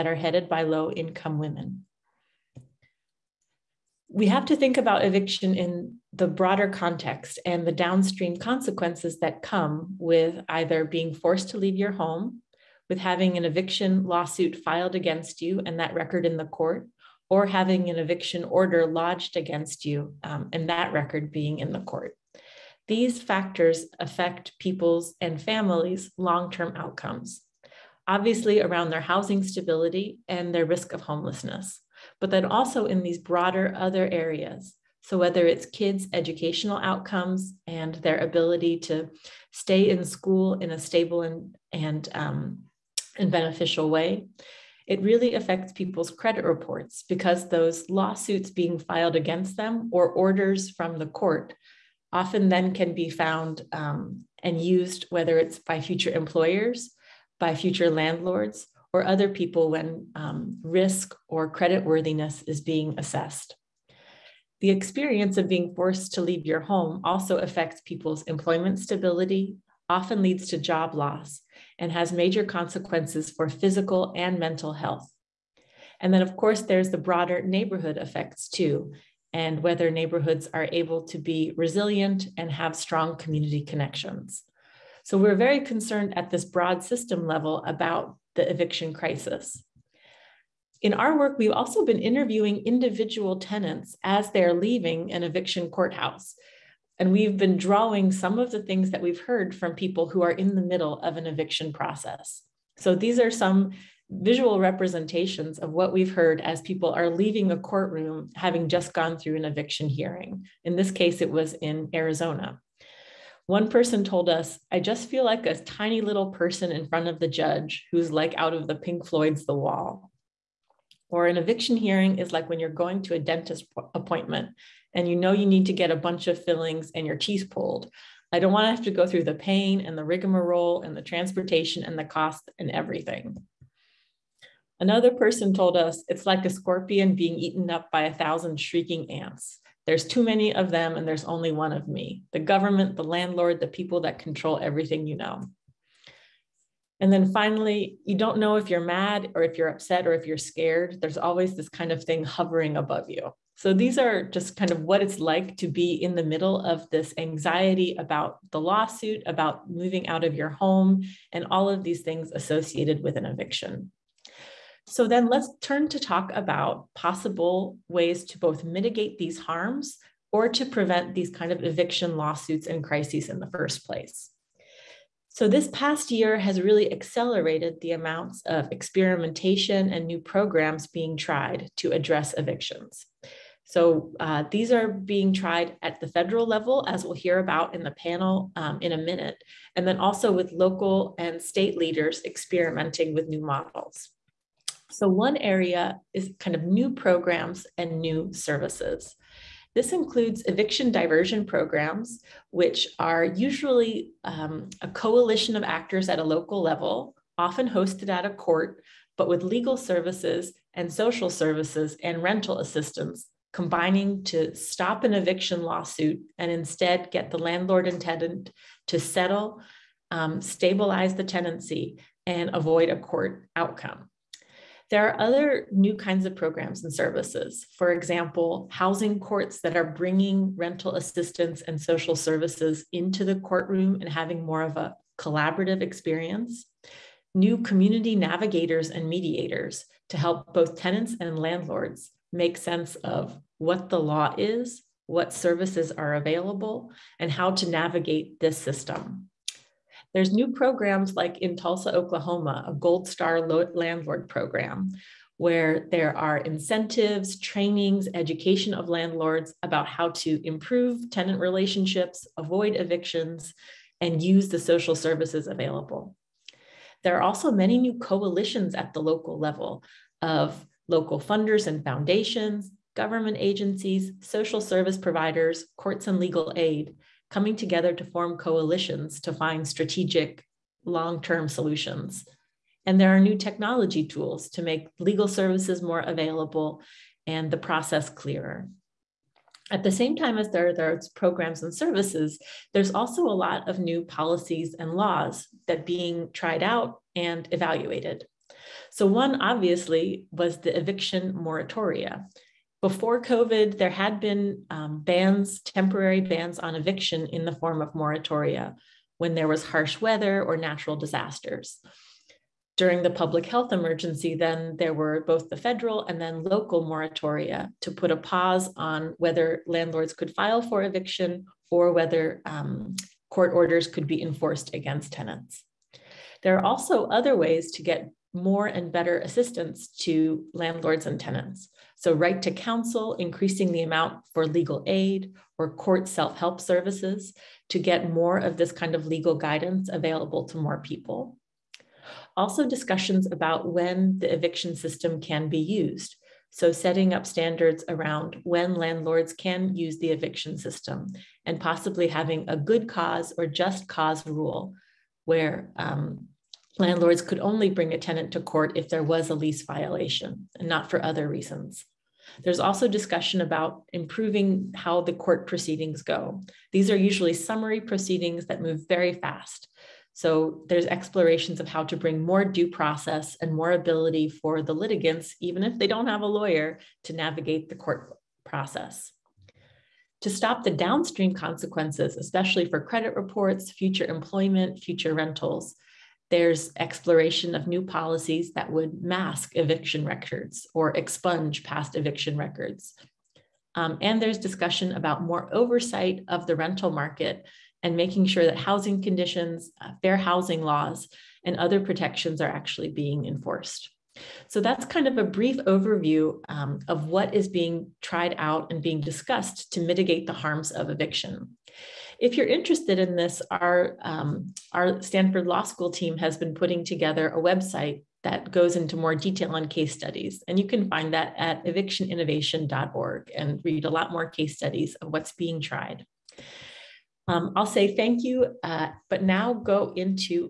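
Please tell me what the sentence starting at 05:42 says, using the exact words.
Also, discussions about when the eviction system can be used.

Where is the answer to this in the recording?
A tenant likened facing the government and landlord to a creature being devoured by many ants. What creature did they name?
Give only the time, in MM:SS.
02:16.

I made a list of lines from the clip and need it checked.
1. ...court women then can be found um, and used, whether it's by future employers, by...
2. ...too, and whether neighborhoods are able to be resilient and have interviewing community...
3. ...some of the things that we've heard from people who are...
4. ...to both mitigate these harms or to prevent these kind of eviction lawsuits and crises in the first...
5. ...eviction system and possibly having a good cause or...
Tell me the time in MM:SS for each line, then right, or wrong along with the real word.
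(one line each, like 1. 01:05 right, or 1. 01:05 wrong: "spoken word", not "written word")
1. 00:51 wrong: "often", not "women"
2. 01:18 wrong: "strong", not "interviewing"
3. 01:38 right
4. 02:48 right
5. 05:50 right.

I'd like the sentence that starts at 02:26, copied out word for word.
And then finally, you don't know if you're mad or if you're upset or if you're scared.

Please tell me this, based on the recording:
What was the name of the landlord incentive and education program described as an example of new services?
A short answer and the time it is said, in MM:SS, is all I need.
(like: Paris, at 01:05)
Gold Star Landlord, at 04:12.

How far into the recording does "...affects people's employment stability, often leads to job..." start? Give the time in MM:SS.
01:07.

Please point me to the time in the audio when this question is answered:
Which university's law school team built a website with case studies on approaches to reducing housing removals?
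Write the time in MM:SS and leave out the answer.
06:55.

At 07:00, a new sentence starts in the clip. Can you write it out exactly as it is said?
And you can find that at evictioninnovation.org and read a lot more case studies of what's being tried.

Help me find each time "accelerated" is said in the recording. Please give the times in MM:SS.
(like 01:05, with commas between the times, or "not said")
02:56.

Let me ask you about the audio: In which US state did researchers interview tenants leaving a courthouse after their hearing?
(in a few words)
Arizona.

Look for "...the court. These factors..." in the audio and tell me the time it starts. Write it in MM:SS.
00:21.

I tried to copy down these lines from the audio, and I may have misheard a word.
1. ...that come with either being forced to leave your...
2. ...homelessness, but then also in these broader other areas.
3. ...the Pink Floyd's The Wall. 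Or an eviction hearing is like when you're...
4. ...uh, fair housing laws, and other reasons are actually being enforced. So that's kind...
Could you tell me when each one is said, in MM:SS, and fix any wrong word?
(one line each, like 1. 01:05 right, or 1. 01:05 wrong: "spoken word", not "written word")
1. 00:09 right
2. 00:31 right
3. 01:58 right
4. 06:39 wrong: "protections", not "reasons".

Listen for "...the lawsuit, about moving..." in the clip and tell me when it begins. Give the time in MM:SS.
02:38.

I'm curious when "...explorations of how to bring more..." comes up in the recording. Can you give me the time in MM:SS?
06:10.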